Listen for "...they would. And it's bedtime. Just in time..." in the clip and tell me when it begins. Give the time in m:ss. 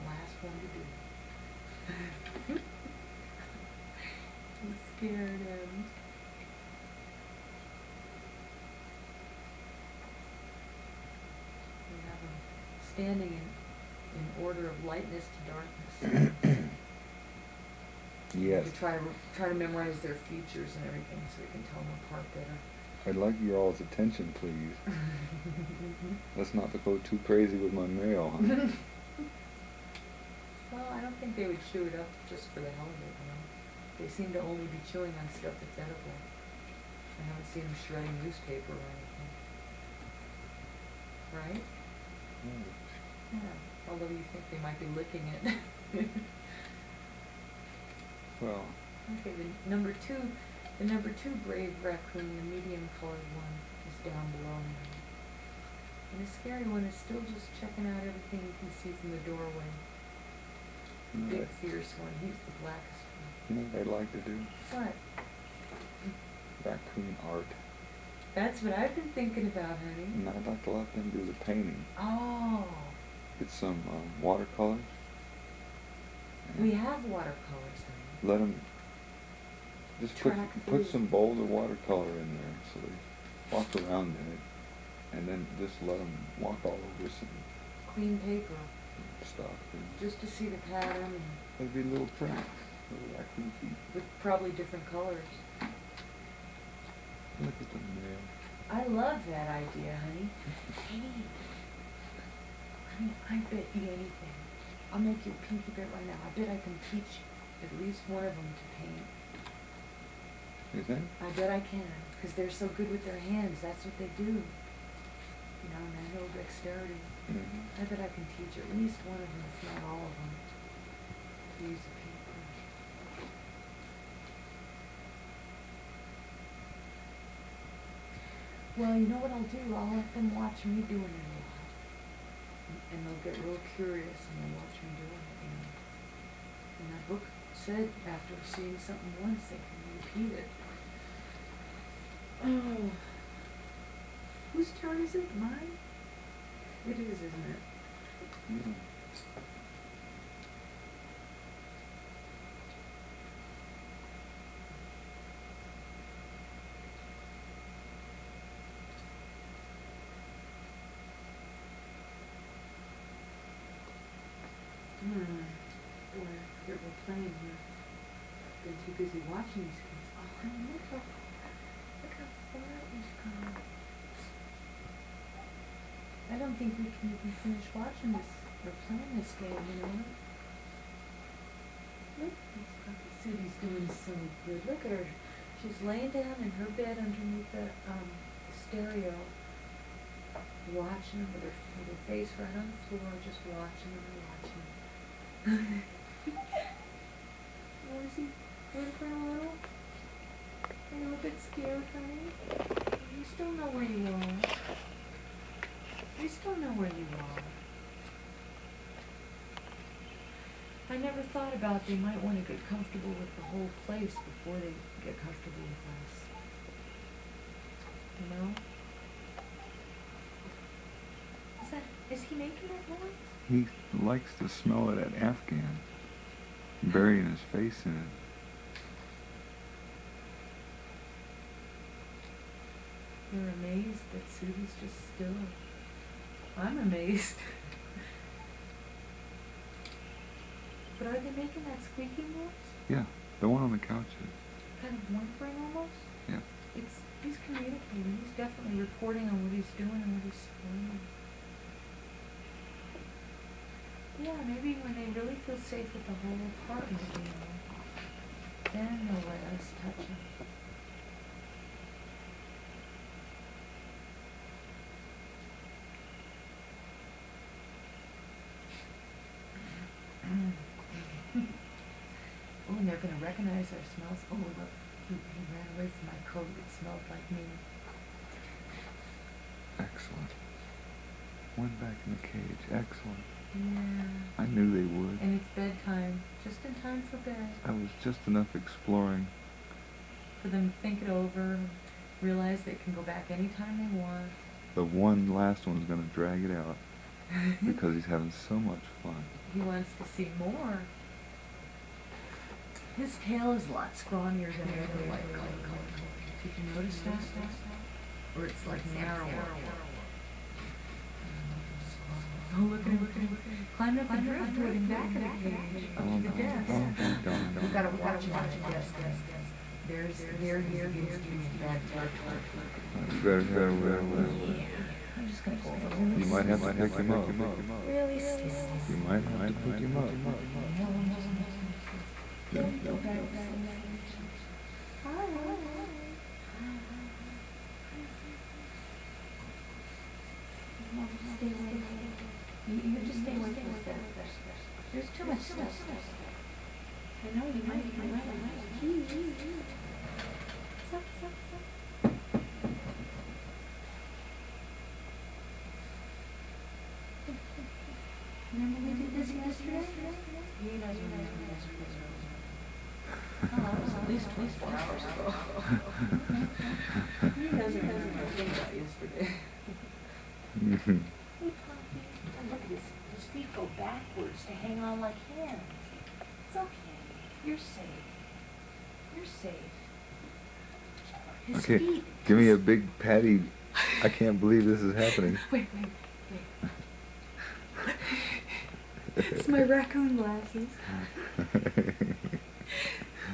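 4:44.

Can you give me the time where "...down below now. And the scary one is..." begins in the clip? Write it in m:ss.
0:54.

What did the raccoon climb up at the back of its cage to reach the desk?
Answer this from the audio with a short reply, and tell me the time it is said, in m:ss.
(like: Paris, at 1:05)
driftwood, at 5:14.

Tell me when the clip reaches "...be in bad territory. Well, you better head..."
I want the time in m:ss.
5:21.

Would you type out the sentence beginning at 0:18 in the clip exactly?
To try, try to memorize their features and everything so we can tell them apart better.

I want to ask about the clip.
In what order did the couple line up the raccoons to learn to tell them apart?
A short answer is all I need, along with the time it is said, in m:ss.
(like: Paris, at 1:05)
lightness to darkness, at 0:14.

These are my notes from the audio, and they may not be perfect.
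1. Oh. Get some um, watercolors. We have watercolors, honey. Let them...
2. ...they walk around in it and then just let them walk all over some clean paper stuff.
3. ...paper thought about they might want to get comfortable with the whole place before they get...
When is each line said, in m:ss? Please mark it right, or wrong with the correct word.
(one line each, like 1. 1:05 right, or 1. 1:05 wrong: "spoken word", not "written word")
1. 1:11 right
2. 1:22 right
3. 3:30 wrong: "never", not "paper".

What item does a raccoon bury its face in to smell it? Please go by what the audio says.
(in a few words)
Afghan.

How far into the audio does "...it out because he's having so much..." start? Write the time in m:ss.
4:56.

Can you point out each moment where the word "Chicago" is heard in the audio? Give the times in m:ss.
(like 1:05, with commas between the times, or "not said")
not said.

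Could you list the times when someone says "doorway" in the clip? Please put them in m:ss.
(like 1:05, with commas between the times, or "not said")
0:59.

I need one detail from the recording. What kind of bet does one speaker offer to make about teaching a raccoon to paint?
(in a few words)
pinky bet.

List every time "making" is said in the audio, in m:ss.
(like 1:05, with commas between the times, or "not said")
3:42, 4:01.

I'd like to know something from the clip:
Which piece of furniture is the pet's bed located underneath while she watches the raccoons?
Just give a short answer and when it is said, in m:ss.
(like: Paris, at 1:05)
the stereo, at 3:08.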